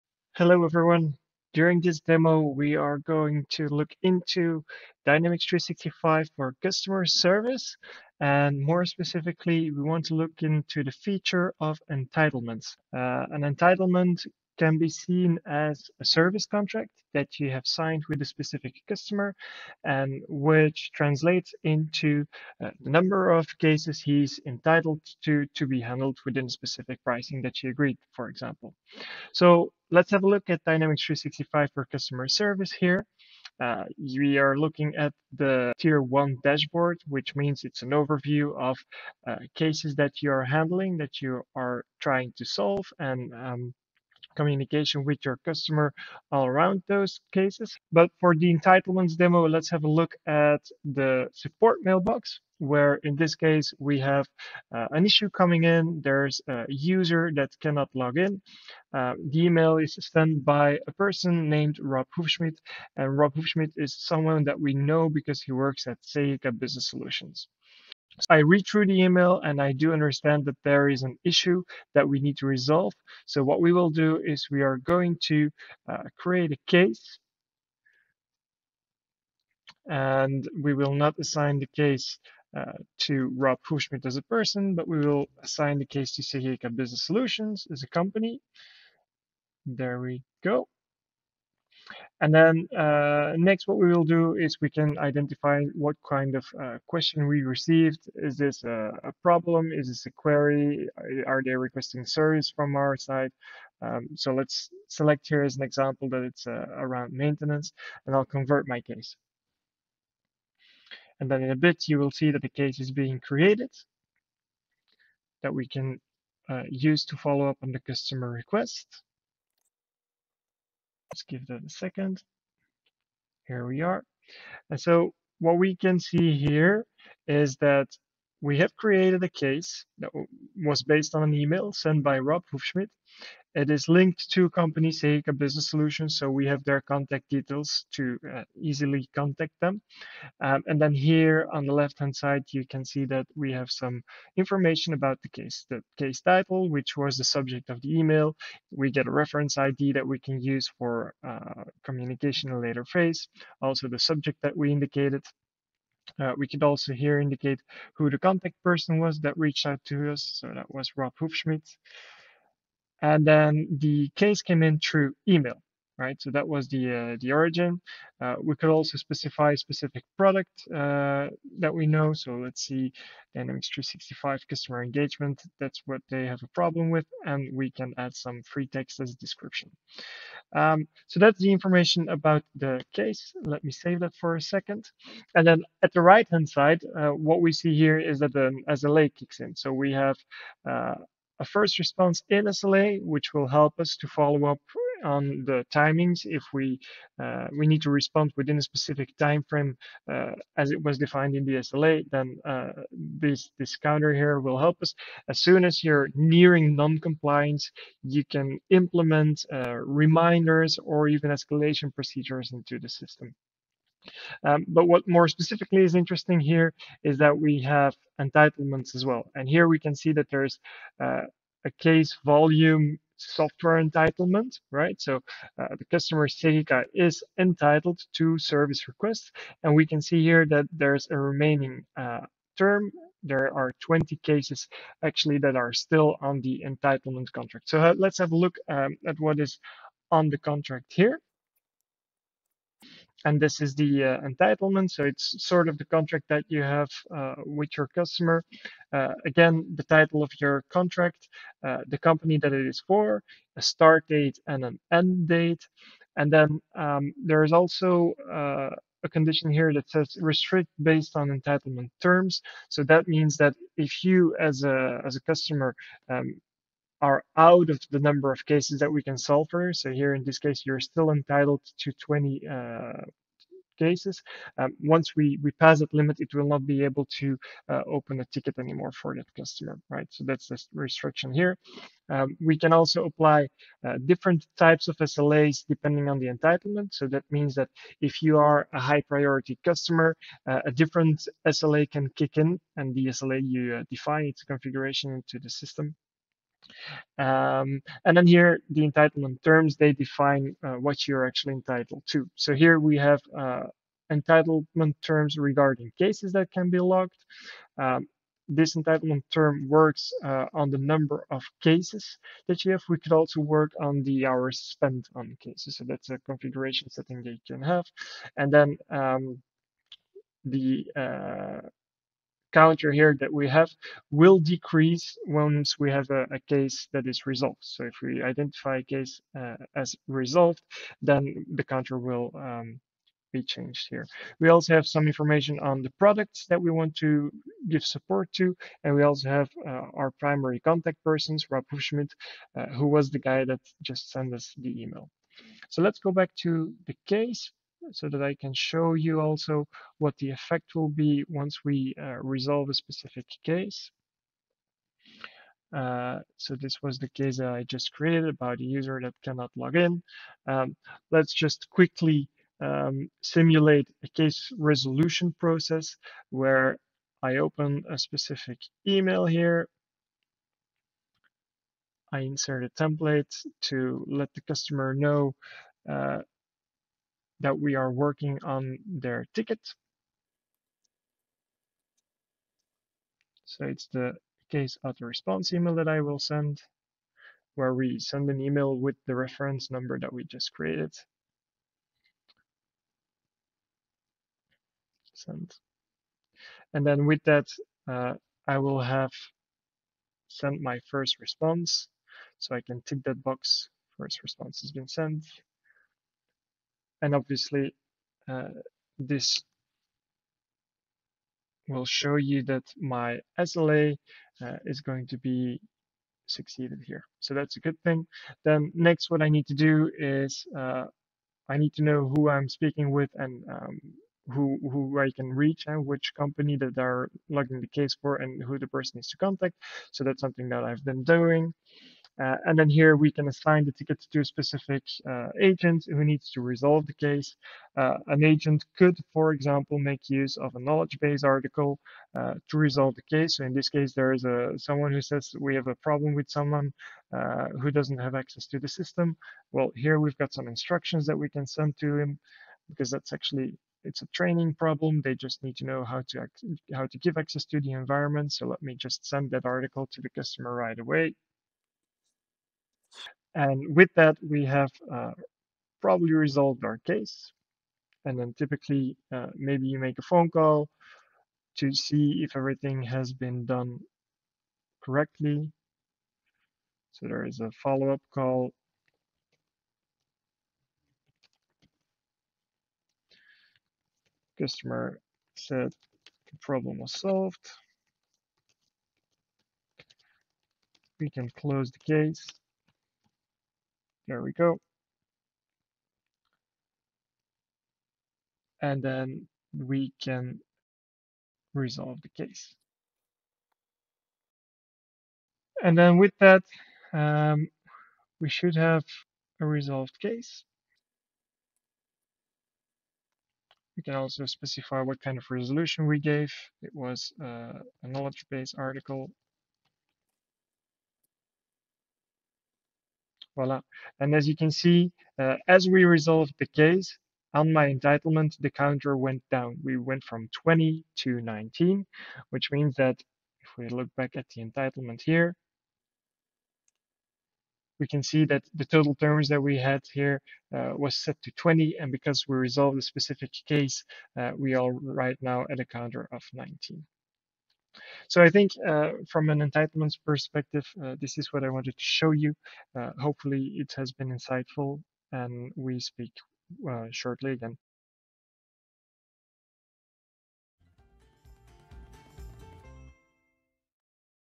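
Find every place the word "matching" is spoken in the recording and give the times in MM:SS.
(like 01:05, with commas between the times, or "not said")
not said.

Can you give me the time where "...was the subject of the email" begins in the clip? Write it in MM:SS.
02:26.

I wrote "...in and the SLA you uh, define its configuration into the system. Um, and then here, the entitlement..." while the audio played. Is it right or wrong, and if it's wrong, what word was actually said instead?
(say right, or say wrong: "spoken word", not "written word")
right.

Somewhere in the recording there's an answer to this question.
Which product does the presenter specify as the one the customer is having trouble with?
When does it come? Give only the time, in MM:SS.
02:53.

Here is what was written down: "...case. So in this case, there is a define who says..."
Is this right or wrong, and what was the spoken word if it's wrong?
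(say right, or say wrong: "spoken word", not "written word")
wrong: "someone", not "define".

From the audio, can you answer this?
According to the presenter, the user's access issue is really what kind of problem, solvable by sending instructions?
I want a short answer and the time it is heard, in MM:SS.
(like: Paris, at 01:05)
A training problem, at 07:34.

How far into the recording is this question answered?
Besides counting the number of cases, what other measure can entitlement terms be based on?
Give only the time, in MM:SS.
05:14.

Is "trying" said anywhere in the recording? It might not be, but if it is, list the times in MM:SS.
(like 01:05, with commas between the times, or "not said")
00:41.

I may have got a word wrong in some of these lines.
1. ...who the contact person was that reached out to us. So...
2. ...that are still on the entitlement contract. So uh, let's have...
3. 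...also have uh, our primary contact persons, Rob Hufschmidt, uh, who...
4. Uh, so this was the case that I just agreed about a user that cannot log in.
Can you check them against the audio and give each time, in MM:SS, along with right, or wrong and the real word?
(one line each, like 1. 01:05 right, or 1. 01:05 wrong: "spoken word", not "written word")
1. 02:37 right
2. 03:55 right
3. 05:39 right
4. 05:55 wrong: "created", not "agreed".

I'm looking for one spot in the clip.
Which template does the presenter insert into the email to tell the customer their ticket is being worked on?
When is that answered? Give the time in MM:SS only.
06:24.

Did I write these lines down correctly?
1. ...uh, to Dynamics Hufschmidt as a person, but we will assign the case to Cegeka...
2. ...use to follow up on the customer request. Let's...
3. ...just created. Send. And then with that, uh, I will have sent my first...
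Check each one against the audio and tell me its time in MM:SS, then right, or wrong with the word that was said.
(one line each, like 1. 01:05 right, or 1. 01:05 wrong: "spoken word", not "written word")
1. 01:22 wrong: "Rob", not "Dynamics"
2. 01:56 right
3. 06:30 right.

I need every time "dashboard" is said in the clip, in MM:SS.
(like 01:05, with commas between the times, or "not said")
00:36.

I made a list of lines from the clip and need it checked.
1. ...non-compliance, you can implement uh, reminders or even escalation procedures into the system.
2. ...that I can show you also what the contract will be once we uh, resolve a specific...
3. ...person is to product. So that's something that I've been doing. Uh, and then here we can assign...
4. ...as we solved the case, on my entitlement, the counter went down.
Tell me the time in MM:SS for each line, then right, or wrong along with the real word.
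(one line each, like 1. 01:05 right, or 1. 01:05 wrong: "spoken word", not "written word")
1. 03:26 right
2. 05:48 wrong: "effect", not "contract"
3. 07:08 wrong: "contact", not "product"
4. 08:45 wrong: "resolved", not "solved".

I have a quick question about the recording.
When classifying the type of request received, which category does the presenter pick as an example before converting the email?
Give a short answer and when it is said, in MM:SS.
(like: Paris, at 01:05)
Maintenance, at 01:47.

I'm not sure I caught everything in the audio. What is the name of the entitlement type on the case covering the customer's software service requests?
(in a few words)
Case volume software entitlement.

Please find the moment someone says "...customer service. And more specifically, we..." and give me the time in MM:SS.
00:06.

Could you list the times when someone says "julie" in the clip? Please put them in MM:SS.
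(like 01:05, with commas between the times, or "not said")
not said.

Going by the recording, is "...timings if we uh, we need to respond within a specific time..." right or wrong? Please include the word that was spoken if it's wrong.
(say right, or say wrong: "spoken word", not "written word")
right.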